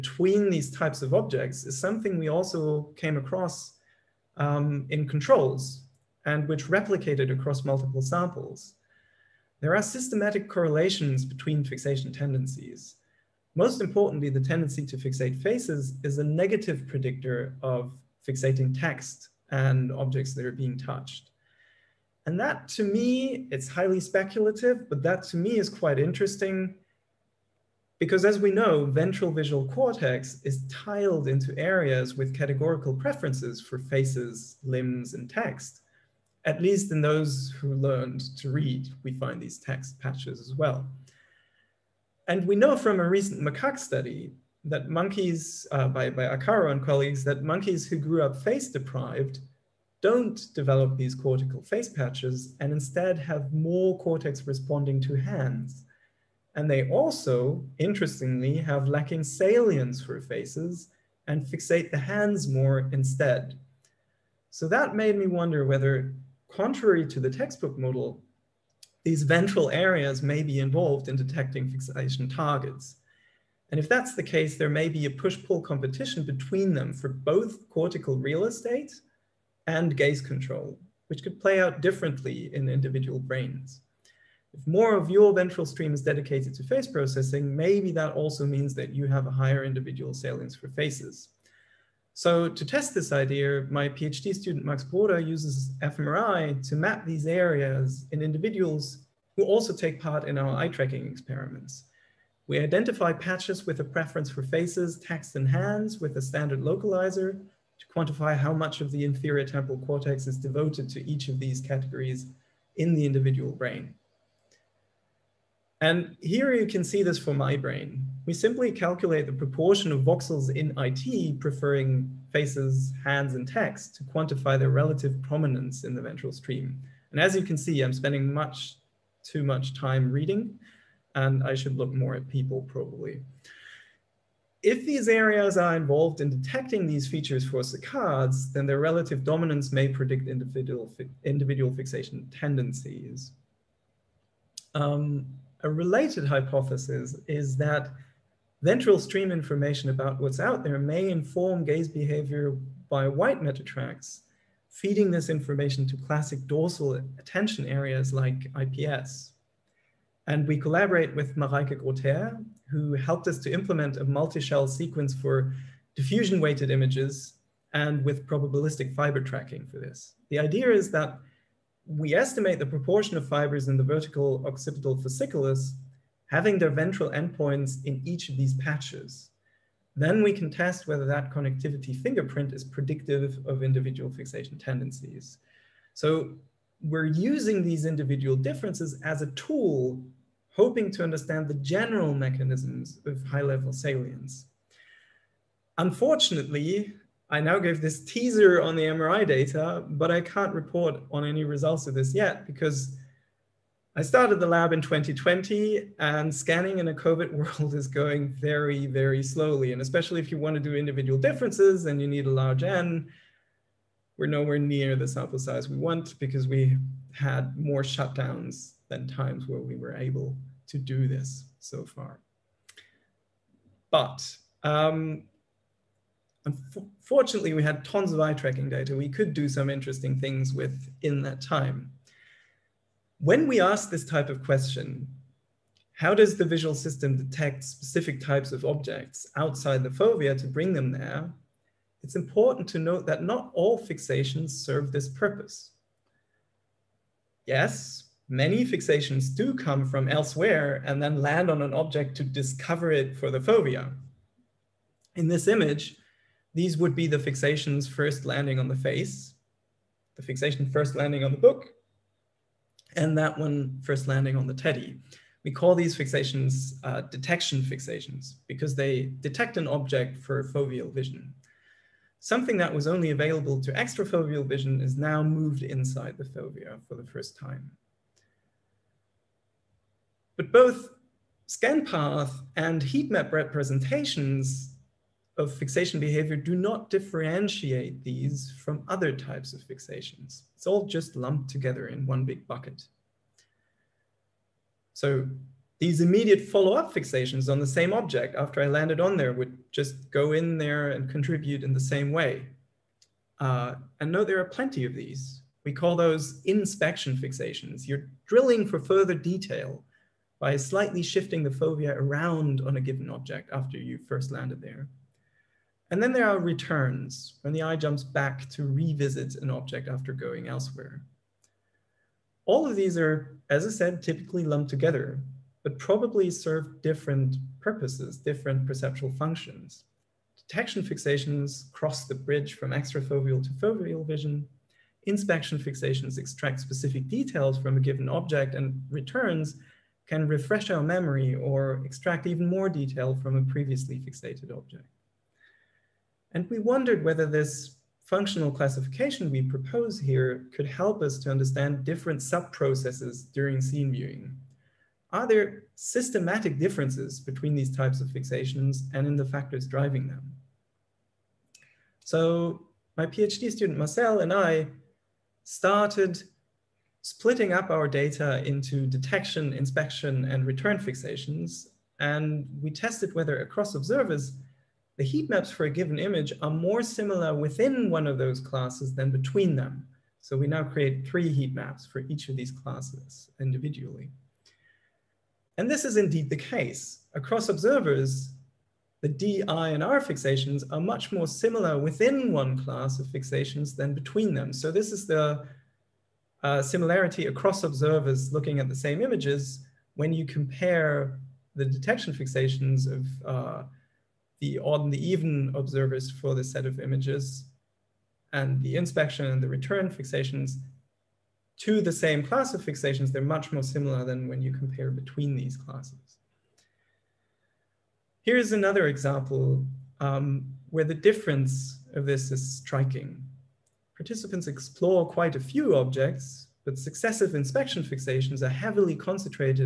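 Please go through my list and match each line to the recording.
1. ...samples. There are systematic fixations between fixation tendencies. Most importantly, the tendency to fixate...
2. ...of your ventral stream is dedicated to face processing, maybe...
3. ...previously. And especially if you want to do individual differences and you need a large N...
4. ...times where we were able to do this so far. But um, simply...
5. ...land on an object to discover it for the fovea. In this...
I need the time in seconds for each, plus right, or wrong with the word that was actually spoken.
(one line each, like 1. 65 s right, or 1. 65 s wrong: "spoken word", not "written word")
1. 8 s wrong: "correlations", not "fixations"
2. 84 s right
3. 209 s wrong: "slowly", not "previously"
4. 219 s wrong: "unfortunately", not "simply"
5. 251 s right.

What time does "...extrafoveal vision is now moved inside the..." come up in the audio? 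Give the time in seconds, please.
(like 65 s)
273 s.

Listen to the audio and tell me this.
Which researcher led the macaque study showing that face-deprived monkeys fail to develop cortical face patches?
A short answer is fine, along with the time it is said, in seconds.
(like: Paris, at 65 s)
Arcaro, at 46 s.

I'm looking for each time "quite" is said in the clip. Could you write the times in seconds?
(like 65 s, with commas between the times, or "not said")
25 s, 425 s.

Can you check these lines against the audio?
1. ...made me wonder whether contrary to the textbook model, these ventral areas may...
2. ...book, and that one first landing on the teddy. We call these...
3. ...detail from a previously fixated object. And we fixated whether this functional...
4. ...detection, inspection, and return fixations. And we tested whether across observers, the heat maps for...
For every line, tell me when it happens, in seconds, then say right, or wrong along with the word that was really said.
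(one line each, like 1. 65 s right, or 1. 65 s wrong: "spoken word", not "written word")
1. 64 s right
2. 261 s right
3. 342 s wrong: "wondered", not "fixated"
4. 368 s right.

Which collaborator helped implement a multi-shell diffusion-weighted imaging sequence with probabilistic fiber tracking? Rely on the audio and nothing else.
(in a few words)
Mareike Grotheer.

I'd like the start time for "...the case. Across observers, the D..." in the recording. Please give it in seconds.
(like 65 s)
386 s.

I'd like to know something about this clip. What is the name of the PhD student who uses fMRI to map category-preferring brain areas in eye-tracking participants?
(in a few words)
Max Broda.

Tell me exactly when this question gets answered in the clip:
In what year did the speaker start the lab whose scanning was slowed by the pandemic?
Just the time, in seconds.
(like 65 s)
204 s.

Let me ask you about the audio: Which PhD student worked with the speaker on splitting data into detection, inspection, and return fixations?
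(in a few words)
Marcel.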